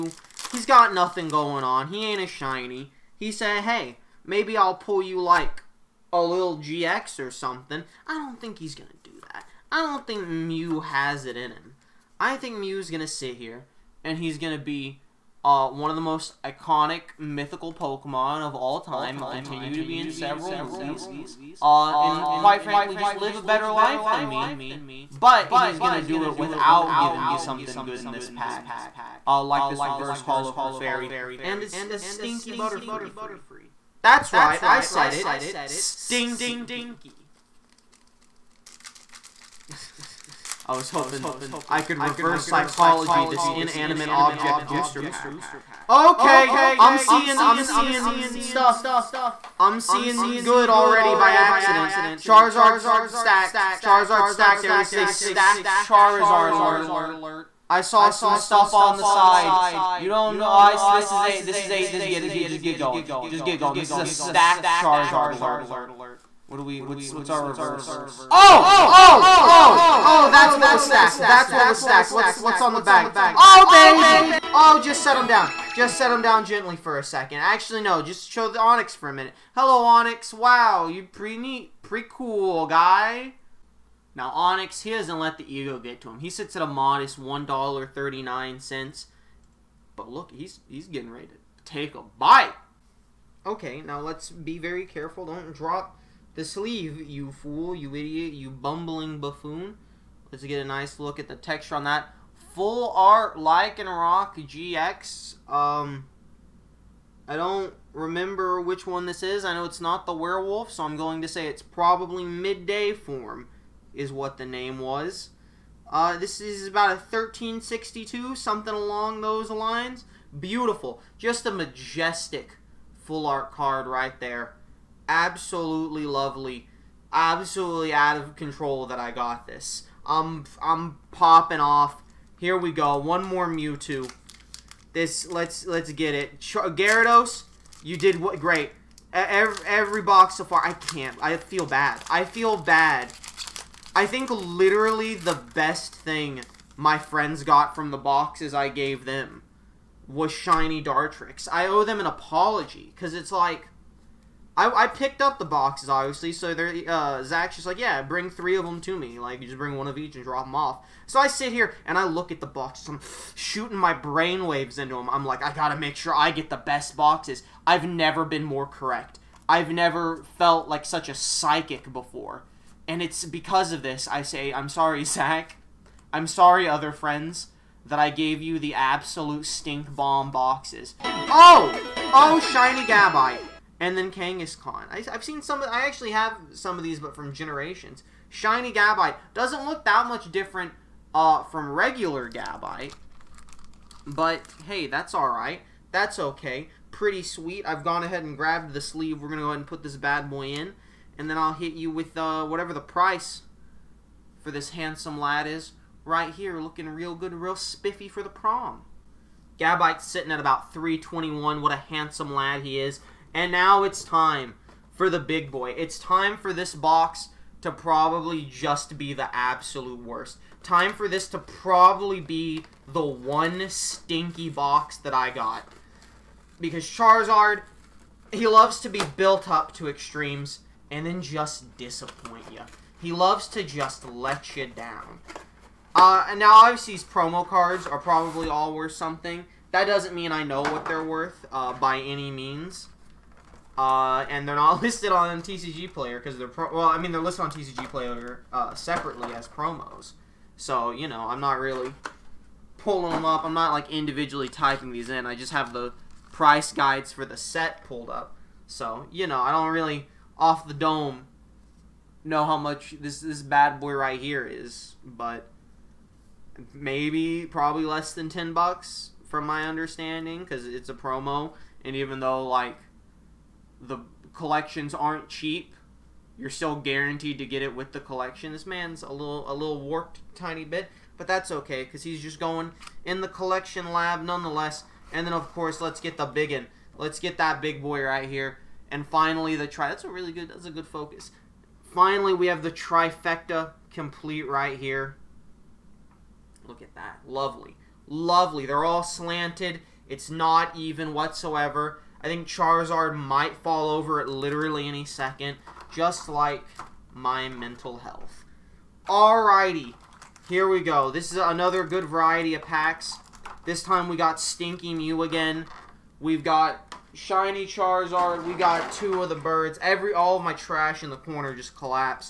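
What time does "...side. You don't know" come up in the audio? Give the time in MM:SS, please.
00:59.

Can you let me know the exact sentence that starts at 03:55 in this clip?
Uh, and now, obviously, these promo cards are probably all worth something.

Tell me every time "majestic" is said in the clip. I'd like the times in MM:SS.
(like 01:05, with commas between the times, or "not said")
02:01.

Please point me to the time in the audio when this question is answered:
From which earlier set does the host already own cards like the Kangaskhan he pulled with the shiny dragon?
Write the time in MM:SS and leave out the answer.
03:07.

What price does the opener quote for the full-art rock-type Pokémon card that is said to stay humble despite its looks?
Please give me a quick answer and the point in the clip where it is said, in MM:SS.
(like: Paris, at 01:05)
$1.39, at 01:27.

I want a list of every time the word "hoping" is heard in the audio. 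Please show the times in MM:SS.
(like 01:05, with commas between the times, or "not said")
00:40.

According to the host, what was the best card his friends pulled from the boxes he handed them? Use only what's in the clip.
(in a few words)
Shiny Dartrix.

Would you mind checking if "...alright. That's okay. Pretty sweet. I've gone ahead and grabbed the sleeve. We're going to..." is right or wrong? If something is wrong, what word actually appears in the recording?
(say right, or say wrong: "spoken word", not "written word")
right.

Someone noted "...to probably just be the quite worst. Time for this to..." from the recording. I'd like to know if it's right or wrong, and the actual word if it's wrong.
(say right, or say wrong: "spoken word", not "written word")
wrong: "absolute", not "quite".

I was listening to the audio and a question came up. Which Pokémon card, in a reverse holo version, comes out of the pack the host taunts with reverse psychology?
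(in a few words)
Clefairy.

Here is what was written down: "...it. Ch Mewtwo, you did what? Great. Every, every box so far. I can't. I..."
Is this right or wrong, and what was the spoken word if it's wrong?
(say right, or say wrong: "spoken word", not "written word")
wrong: "Gyarados", not "Mewtwo".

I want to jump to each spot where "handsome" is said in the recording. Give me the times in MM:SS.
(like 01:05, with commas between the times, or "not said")
03:24, 03:31.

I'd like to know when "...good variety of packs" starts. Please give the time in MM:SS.
05:11.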